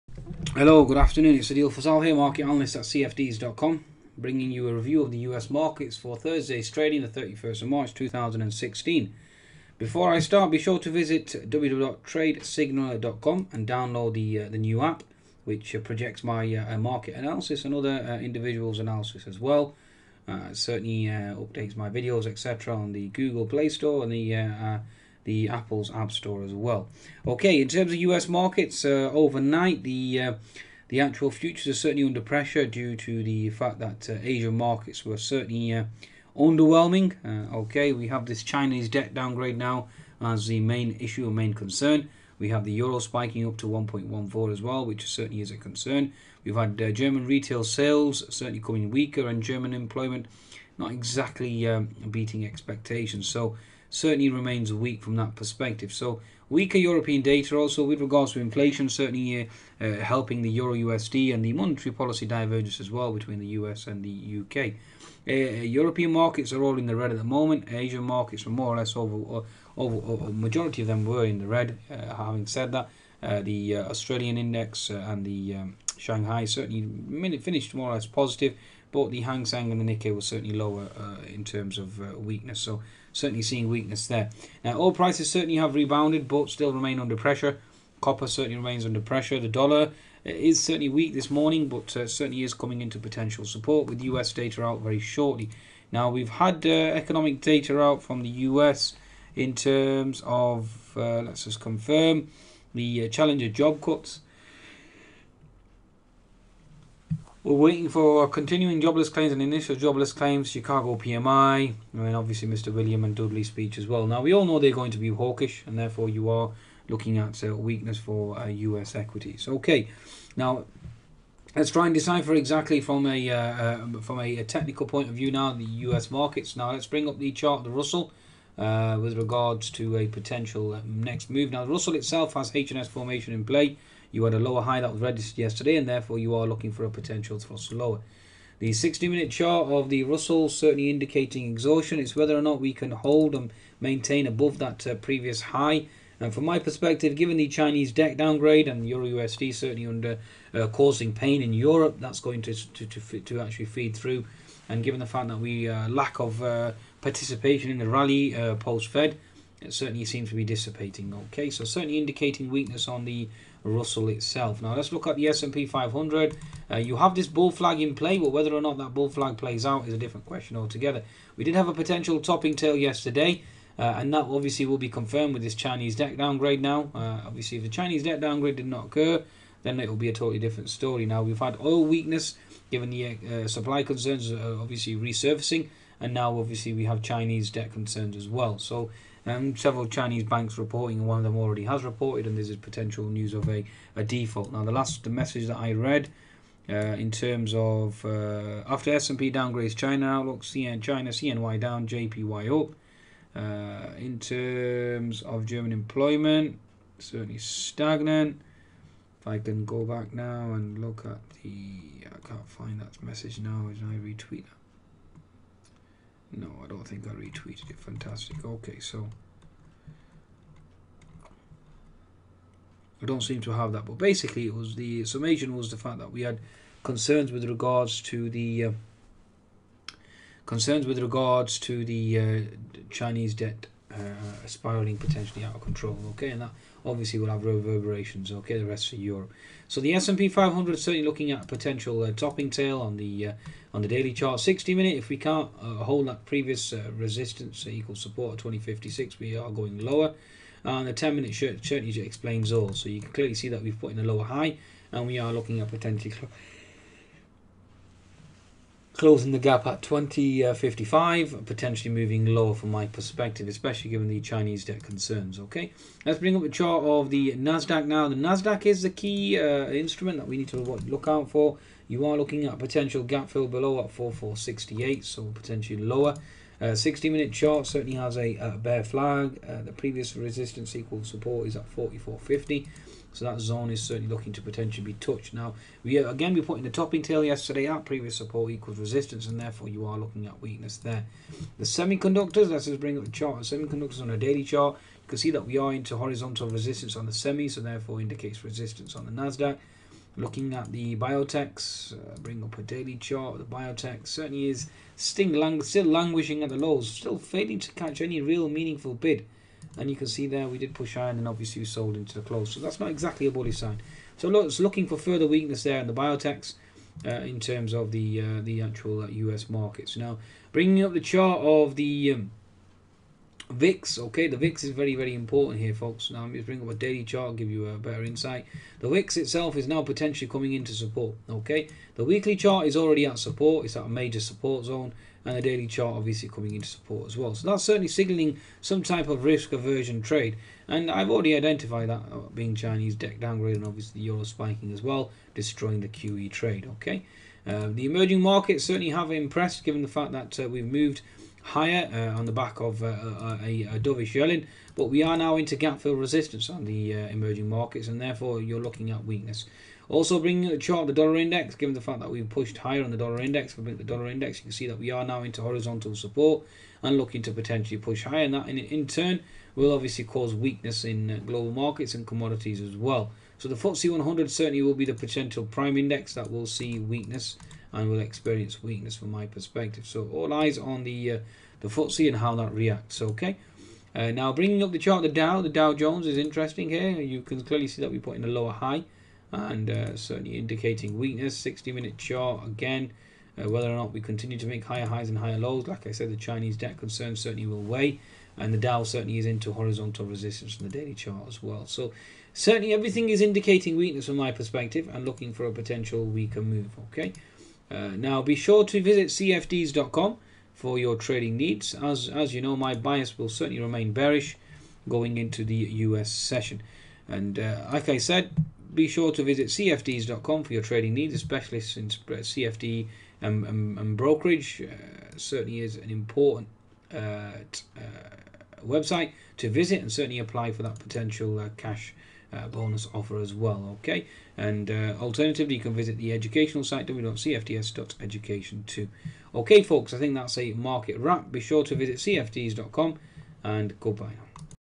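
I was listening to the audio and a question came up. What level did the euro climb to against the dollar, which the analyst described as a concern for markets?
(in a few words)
1.14.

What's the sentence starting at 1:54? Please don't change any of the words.
Now, we all know they're going to be hawkish, and therefore you are looking at a uh, weakness for uh, US equities.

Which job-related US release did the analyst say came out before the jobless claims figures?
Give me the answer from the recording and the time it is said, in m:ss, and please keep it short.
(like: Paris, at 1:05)
Challenger job cuts, at 1:43.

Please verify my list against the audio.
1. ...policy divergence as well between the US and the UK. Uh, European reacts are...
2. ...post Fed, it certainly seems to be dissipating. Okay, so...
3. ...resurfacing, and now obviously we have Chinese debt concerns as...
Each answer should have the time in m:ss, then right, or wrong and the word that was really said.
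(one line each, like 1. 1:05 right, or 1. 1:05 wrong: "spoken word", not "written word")
1. 1:01 wrong: "markets", not "reacts"
2. 2:38 right
3. 3:04 right.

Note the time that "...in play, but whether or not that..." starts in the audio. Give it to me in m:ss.
2:47.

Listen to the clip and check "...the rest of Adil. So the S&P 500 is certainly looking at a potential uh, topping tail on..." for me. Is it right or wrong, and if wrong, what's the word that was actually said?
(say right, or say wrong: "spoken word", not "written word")
wrong: "Europe", not "Adil".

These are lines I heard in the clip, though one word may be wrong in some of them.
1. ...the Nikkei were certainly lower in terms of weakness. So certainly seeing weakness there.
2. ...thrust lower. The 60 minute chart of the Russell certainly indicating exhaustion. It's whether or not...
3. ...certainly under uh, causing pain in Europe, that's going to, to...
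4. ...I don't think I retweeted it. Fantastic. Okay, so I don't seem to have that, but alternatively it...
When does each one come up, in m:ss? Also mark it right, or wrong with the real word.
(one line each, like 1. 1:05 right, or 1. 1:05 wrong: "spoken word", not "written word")
1. 1:19 right
2. 2:17 right
3. 2:29 right
4. 3:36 wrong: "basically", not "alternatively".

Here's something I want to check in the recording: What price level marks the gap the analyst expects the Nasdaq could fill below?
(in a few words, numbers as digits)
4468.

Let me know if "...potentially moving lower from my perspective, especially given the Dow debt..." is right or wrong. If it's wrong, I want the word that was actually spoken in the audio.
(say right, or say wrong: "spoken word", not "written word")
wrong: "Chinese", not "Dow".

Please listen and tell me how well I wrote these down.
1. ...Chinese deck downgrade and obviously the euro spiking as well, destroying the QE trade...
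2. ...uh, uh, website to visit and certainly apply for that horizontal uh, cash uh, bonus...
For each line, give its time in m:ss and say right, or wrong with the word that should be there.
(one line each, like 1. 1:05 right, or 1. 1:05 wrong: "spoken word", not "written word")
1. 5:42 right
2. 7:06 wrong: "potential", not "horizontal".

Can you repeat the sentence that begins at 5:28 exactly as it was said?
The VIX itself is now potentially coming into support, okay.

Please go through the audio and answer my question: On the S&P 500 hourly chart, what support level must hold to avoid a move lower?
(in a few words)
2056.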